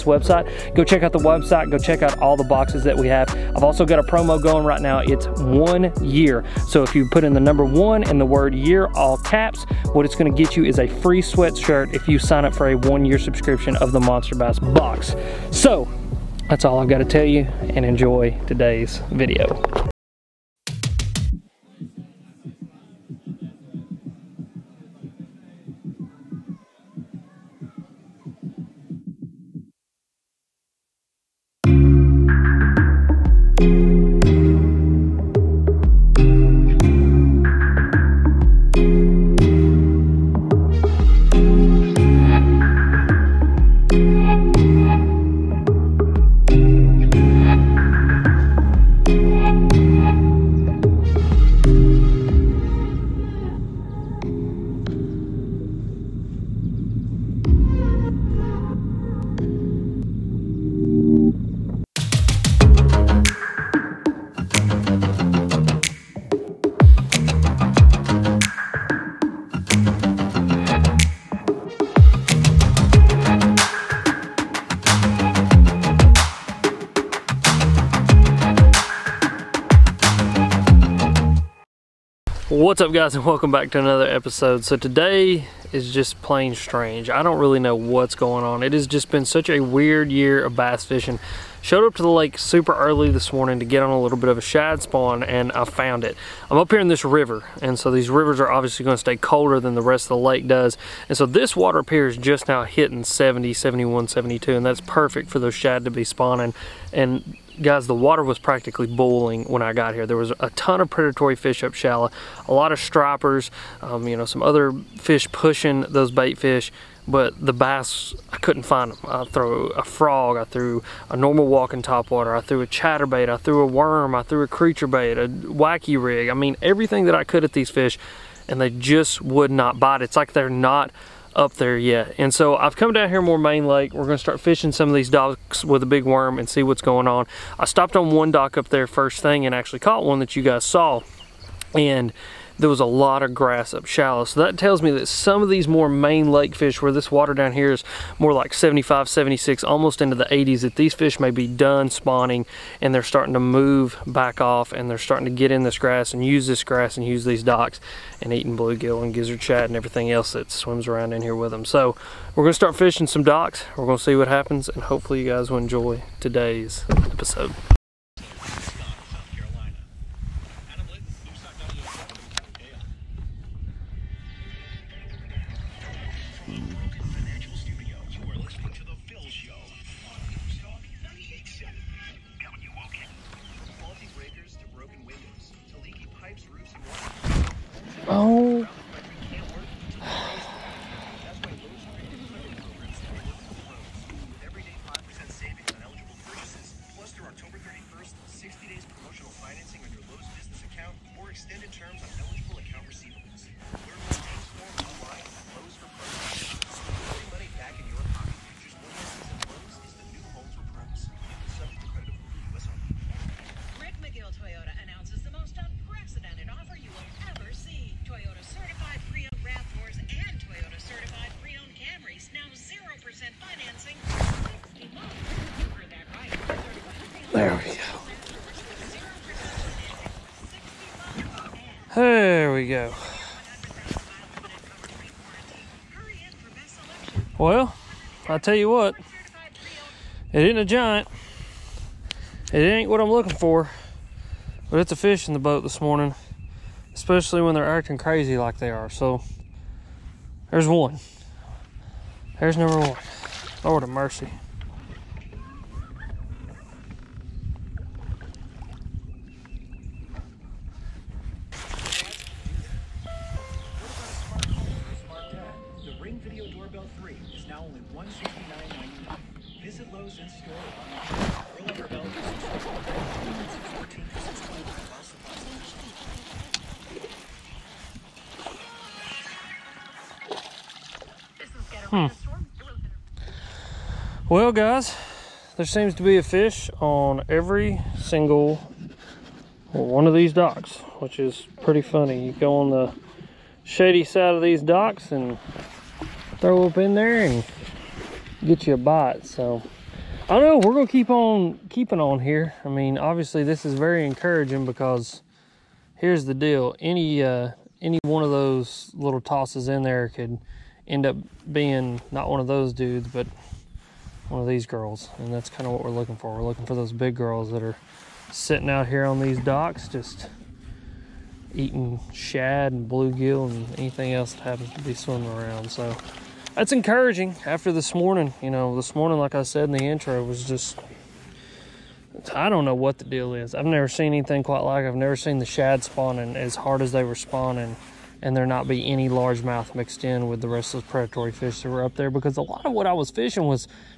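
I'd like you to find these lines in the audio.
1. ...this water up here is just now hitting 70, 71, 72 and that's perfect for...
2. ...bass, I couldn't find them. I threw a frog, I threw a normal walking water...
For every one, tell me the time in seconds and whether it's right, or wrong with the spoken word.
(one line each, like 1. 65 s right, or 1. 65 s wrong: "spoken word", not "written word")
1. 101 s right
2. 117 s wrong: "topwater", not "water".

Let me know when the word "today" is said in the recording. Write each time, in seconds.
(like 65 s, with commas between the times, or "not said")
18 s, 84 s, 166 s.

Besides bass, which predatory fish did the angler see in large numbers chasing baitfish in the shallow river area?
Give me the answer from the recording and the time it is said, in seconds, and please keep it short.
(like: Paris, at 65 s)
stripers, at 112 s.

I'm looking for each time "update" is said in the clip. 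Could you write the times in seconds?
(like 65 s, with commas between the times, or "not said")
not said.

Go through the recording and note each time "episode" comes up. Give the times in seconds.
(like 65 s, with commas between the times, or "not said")
84 s, 166 s.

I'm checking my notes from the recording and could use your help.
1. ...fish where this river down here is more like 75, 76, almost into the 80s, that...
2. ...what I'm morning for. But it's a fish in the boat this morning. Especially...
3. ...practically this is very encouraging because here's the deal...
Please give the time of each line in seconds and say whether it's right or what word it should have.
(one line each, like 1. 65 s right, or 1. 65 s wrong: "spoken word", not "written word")
1. 146 s wrong: "water", not "river"
2. 242 s wrong: "looking", not "morning"
3. 302 s wrong: "obviously", not "practically".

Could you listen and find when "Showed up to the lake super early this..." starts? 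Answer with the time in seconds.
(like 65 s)
91 s.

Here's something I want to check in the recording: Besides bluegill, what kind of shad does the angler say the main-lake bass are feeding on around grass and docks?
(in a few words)
gizzard shad.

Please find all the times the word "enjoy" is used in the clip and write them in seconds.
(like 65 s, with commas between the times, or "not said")
17 s, 165 s.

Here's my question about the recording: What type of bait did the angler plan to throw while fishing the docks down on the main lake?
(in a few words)
big worm.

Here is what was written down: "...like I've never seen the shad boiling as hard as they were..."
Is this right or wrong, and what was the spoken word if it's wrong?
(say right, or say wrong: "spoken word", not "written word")
wrong: "spawning", not "boiling".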